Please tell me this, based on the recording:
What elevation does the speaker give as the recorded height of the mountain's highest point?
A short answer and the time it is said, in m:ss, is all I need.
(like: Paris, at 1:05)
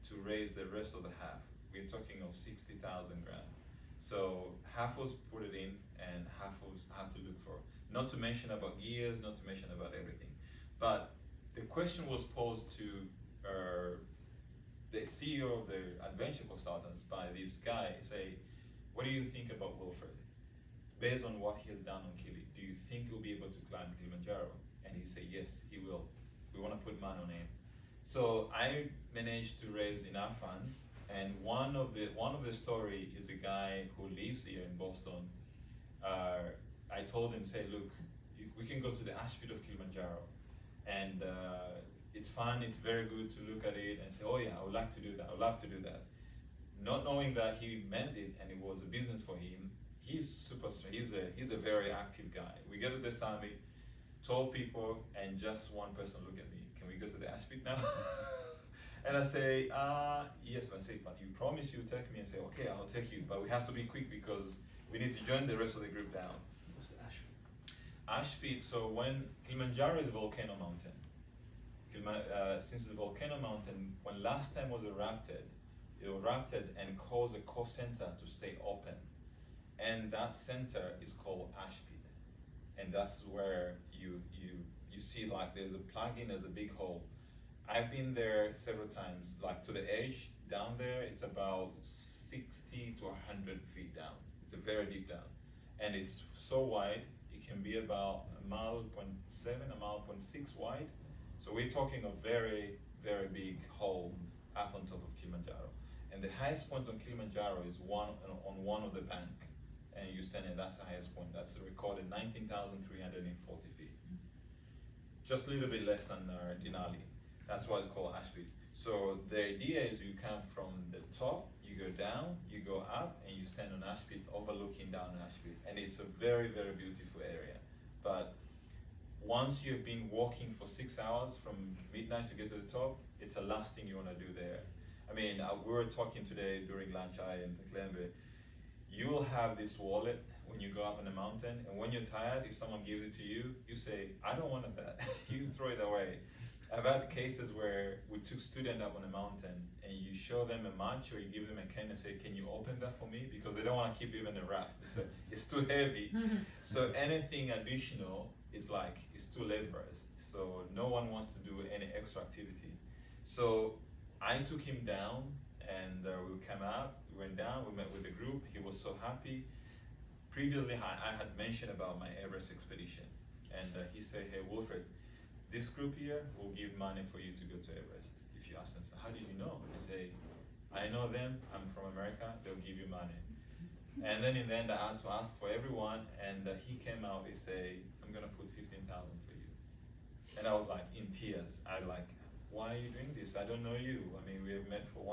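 19,340 feet, at 1:52.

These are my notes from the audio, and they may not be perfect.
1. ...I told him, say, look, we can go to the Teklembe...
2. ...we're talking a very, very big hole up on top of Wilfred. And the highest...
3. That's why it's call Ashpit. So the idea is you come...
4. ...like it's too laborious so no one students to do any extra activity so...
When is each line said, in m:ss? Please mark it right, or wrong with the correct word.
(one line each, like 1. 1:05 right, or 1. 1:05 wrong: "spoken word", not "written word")
1. 0:36 wrong: "Ashfield", not "Teklembe"
2. 1:41 wrong: "Kilimanjaro", not "Wilfred"
3. 1:57 right
4. 2:38 wrong: "wants", not "students".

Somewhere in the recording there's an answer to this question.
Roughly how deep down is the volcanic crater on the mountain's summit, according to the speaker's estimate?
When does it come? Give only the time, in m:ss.
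1:31.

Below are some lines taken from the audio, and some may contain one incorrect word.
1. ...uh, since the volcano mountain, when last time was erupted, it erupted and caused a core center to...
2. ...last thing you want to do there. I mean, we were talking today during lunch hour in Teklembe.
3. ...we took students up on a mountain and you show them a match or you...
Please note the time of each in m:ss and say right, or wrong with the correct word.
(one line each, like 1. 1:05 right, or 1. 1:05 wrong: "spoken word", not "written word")
1. 1:12 right
2. 2:13 right
3. 2:28 right.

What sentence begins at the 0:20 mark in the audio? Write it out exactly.
Based on what he has done on Kili, do you think he'll be able to climb Kilimanjaro?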